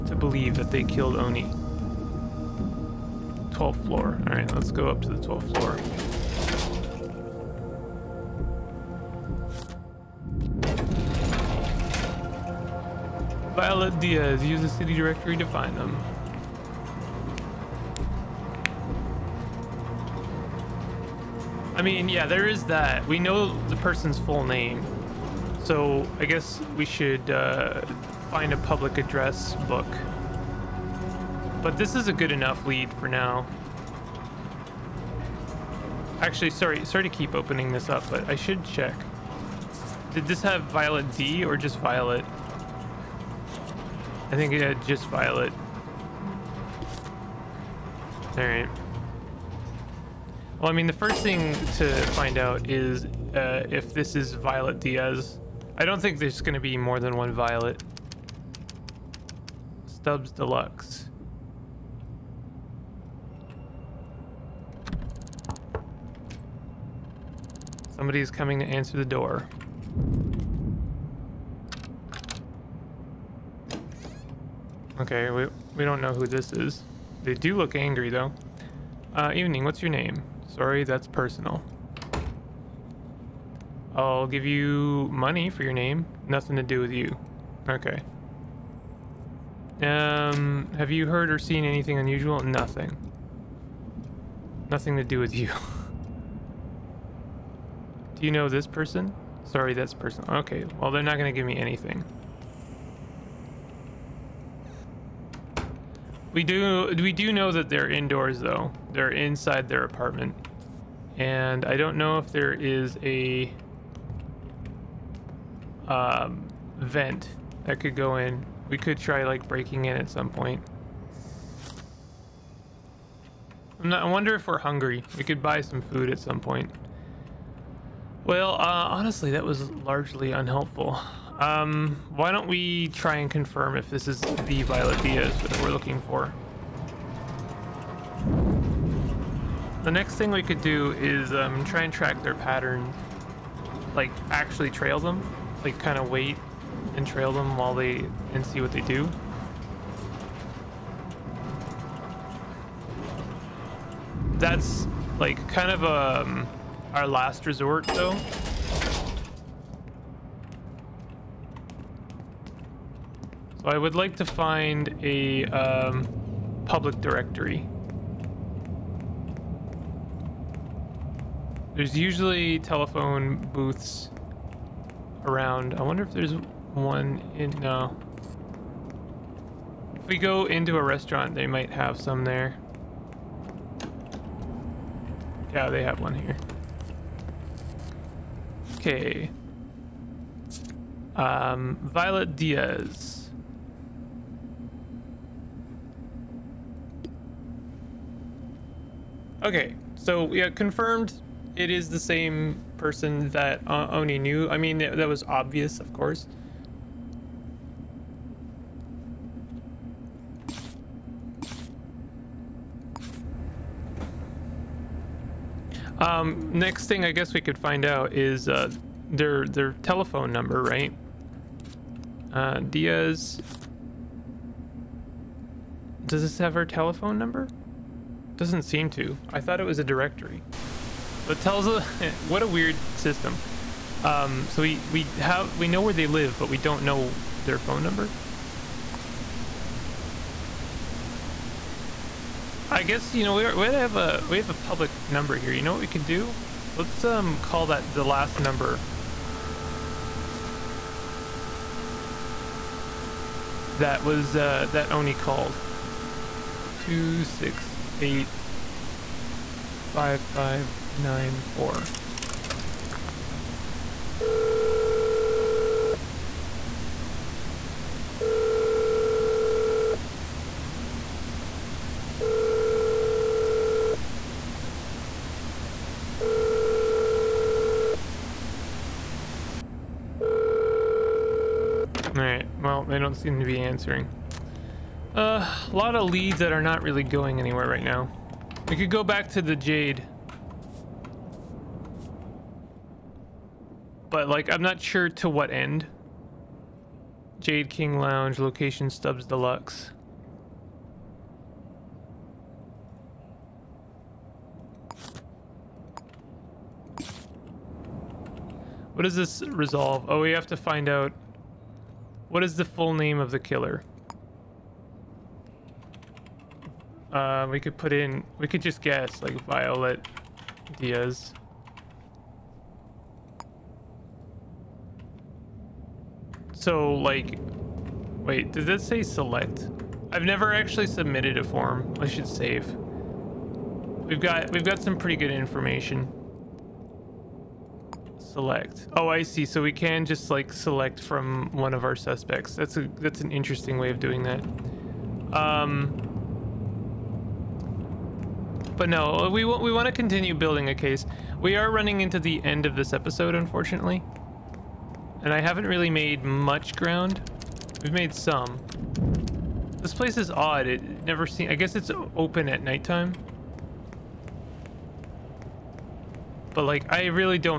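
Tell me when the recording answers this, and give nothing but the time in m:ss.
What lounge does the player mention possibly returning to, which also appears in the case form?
4:57.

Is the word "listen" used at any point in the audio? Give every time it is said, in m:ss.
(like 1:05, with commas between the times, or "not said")
not said.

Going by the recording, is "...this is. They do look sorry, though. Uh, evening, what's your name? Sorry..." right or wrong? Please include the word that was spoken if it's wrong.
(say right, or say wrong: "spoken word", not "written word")
wrong: "angry", not "sorry".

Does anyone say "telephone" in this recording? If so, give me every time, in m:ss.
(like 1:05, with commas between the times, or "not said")
2:52, 3:39, 3:46.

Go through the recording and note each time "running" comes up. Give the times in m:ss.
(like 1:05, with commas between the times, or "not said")
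5:51.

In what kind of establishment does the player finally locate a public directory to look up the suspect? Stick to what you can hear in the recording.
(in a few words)
restaurant.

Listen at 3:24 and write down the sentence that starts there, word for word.
I mean, that was obvious, of course.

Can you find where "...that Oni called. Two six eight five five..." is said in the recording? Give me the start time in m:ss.
4:14.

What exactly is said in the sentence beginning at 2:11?
Um, why don't we try and confirm if this is the Violet Diaz that we're looking for?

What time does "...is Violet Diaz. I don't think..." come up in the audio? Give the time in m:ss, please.
0:54.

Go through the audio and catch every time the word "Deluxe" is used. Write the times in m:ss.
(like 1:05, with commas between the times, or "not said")
1:00, 4:59.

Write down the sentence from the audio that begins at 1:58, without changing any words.
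We could try like breaking in at some point.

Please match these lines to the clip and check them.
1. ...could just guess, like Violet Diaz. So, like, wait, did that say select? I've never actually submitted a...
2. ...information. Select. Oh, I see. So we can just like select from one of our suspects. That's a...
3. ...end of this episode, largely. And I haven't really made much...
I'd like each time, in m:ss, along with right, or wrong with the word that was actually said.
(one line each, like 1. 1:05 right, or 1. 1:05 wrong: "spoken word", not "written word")
1. 5:18 right
2. 5:35 right
3. 5:52 wrong: "unfortunately", not "largely".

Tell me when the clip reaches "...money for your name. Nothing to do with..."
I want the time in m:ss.
1:25.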